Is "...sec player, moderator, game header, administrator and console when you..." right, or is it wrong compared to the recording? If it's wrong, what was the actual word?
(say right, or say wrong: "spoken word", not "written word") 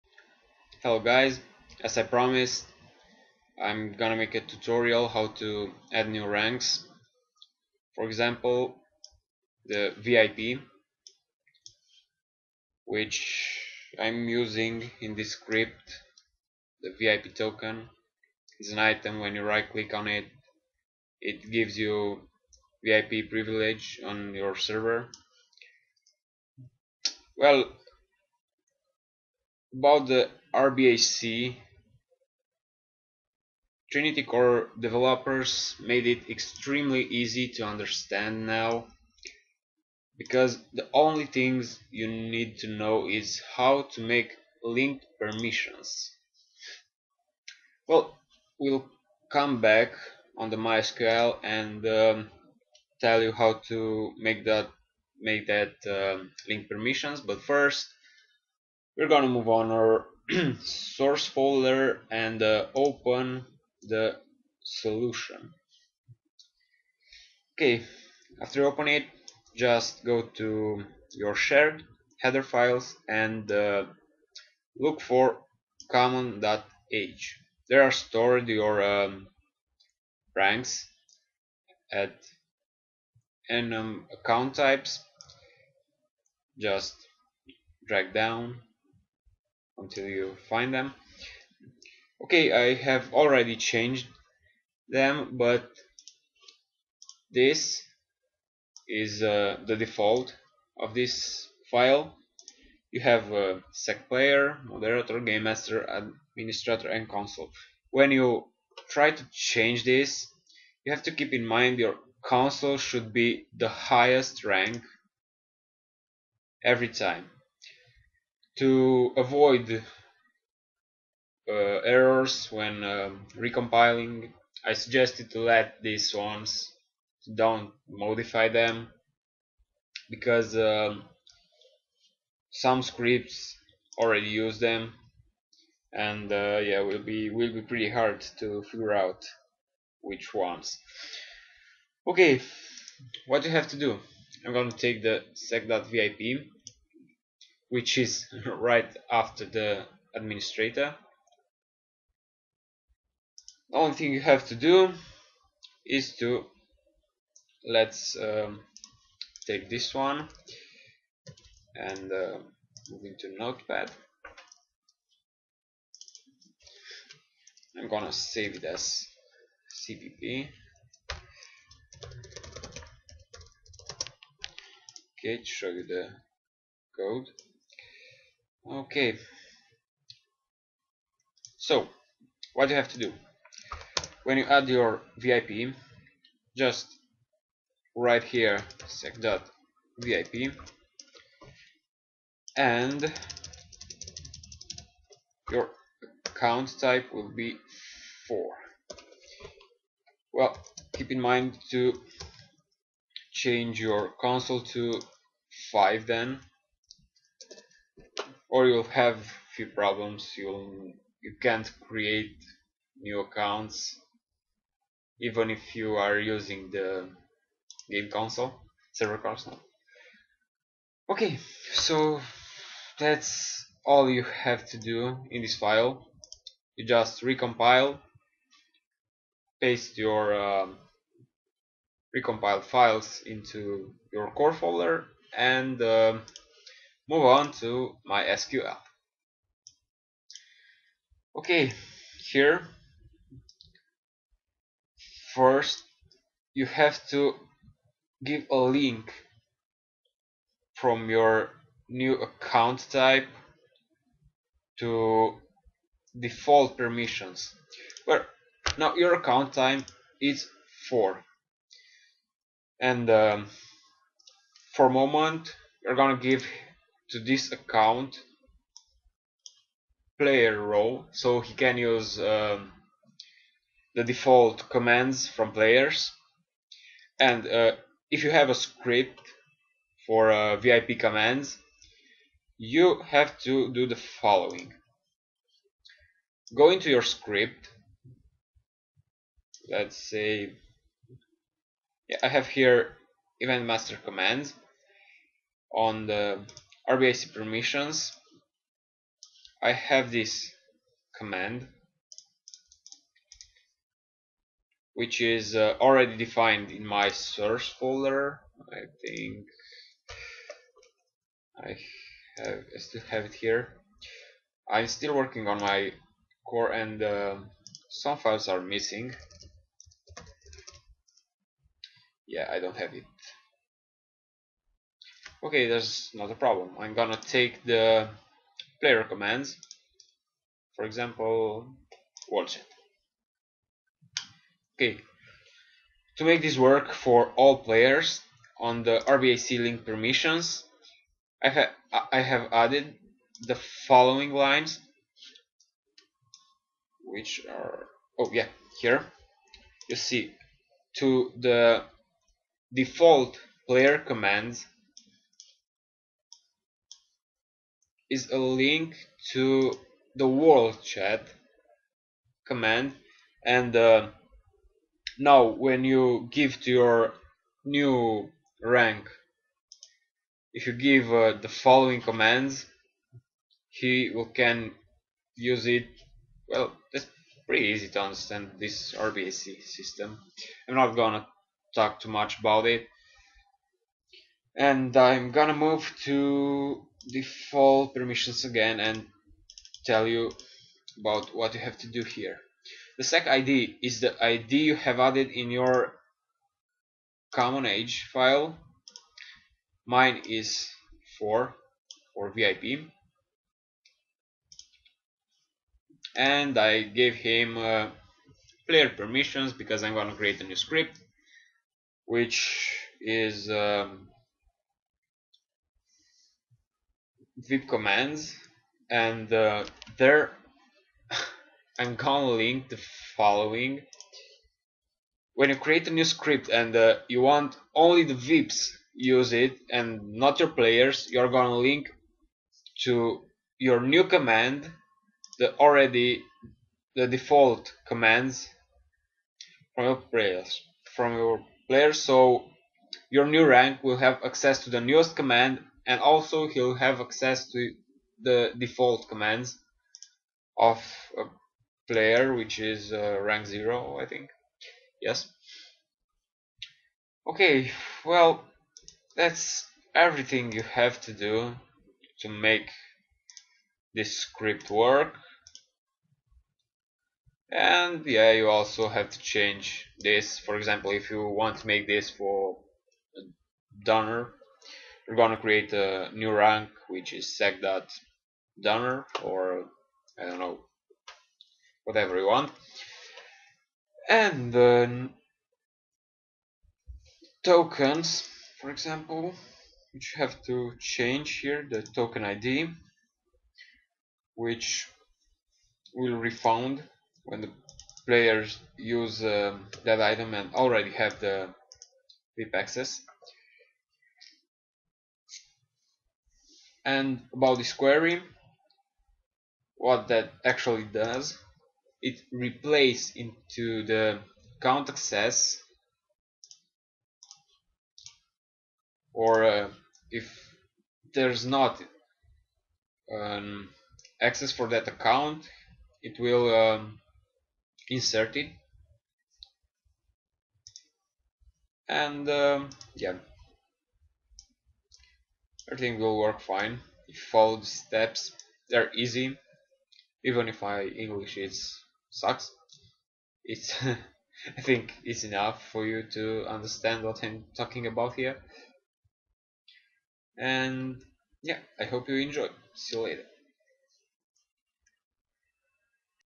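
wrong: "master", not "header".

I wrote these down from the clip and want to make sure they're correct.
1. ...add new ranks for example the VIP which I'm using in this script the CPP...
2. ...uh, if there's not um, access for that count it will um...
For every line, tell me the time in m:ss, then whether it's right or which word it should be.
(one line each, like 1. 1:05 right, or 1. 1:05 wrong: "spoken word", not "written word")
1. 0:05 wrong: "VIP", not "CPP"
2. 8:39 wrong: "account", not "count".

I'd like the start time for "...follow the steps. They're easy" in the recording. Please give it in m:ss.
8:57.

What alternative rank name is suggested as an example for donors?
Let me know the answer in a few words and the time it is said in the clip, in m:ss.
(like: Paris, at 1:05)
sec.donor, at 7:57.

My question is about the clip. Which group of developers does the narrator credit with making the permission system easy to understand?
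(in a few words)
Trinity Core developers.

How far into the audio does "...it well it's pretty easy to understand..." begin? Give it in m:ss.
6:15.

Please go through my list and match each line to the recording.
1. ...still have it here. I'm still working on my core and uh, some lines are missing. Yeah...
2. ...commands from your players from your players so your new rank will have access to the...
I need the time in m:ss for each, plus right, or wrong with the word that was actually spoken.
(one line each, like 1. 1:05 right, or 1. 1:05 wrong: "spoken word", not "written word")
1. 5:12 wrong: "files", not "lines"
2. 7:17 right.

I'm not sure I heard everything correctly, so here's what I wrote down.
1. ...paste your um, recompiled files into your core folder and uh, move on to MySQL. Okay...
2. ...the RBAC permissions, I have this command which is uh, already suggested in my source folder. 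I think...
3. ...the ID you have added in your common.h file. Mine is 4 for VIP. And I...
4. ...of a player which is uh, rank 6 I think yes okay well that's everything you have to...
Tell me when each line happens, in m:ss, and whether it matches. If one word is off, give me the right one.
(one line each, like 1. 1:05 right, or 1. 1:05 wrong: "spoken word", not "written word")
1. 3:49 right
2. 4:56 wrong: "defined", not "suggested"
3. 6:34 right
4. 7:30 wrong: "0", not "6".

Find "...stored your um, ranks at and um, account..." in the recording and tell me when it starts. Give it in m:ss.
1:17.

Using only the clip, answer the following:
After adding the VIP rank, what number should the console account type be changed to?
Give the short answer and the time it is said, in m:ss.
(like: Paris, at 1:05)
5, at 3:25.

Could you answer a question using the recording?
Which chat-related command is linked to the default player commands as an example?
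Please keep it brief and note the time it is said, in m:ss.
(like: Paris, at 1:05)
world chat command, at 6:00.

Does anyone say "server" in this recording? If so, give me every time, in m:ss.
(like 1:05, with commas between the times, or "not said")
0:24, 3:38.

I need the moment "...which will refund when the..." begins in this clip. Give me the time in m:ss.
8:14.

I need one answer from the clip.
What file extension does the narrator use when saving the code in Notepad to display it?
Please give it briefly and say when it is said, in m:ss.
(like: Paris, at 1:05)
CPP, at 2:49.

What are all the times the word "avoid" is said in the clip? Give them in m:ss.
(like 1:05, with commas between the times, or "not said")
1:59.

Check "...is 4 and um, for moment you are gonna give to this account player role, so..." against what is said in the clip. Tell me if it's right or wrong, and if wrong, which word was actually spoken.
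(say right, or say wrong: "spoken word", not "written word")
right.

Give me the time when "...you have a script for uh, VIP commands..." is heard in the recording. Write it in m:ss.
4:38.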